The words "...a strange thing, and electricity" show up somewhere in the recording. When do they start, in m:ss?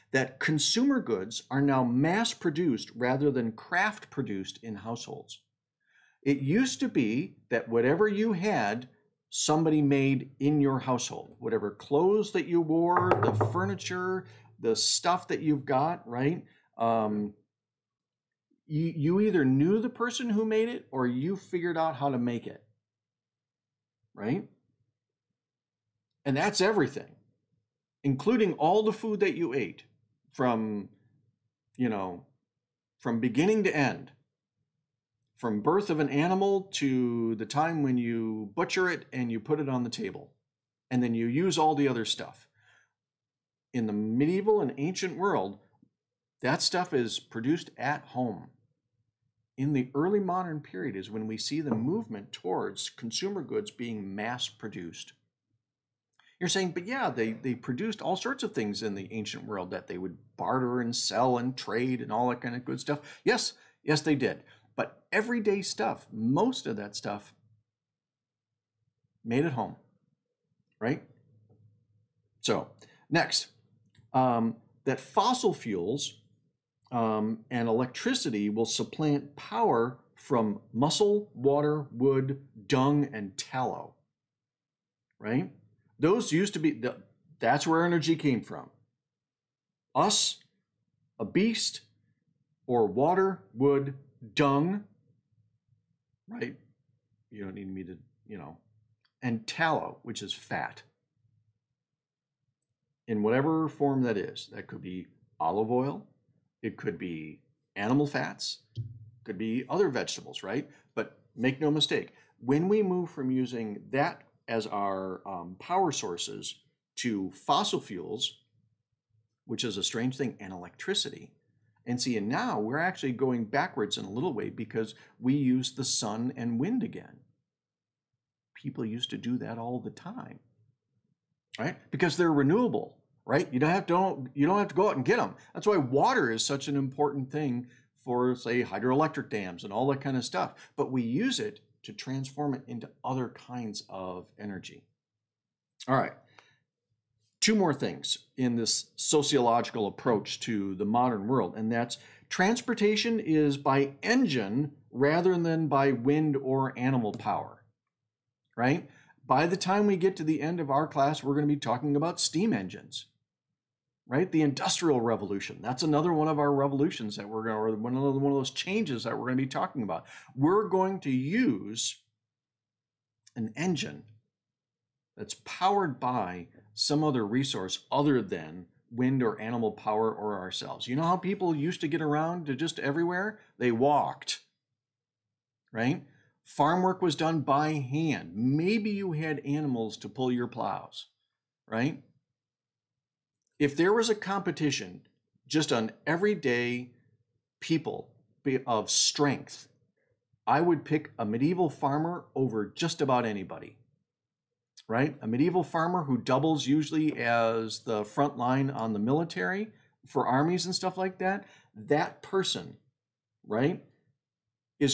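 1:59.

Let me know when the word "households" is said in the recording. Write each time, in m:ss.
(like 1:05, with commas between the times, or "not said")
0:04, 0:10.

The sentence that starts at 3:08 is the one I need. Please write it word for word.
Maybe you had animals to pull your plows, right?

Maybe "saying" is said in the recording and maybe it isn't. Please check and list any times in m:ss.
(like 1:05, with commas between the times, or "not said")
0:56.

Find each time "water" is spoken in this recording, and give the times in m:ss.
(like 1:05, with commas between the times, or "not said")
1:21, 1:32, 2:15.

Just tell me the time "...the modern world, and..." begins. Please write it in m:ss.
2:30.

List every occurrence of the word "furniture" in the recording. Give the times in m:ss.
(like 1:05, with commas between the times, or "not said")
0:13.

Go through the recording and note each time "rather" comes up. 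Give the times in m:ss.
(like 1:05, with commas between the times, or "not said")
0:02, 2:34.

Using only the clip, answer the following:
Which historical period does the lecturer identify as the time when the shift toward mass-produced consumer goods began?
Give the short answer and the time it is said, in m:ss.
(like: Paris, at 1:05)
Early modern period, at 0:49.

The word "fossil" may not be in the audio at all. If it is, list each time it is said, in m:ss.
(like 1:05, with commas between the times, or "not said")
1:14, 1:57.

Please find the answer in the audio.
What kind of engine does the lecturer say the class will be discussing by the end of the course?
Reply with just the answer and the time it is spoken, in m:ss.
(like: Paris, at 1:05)
Steam engines, at 2:42.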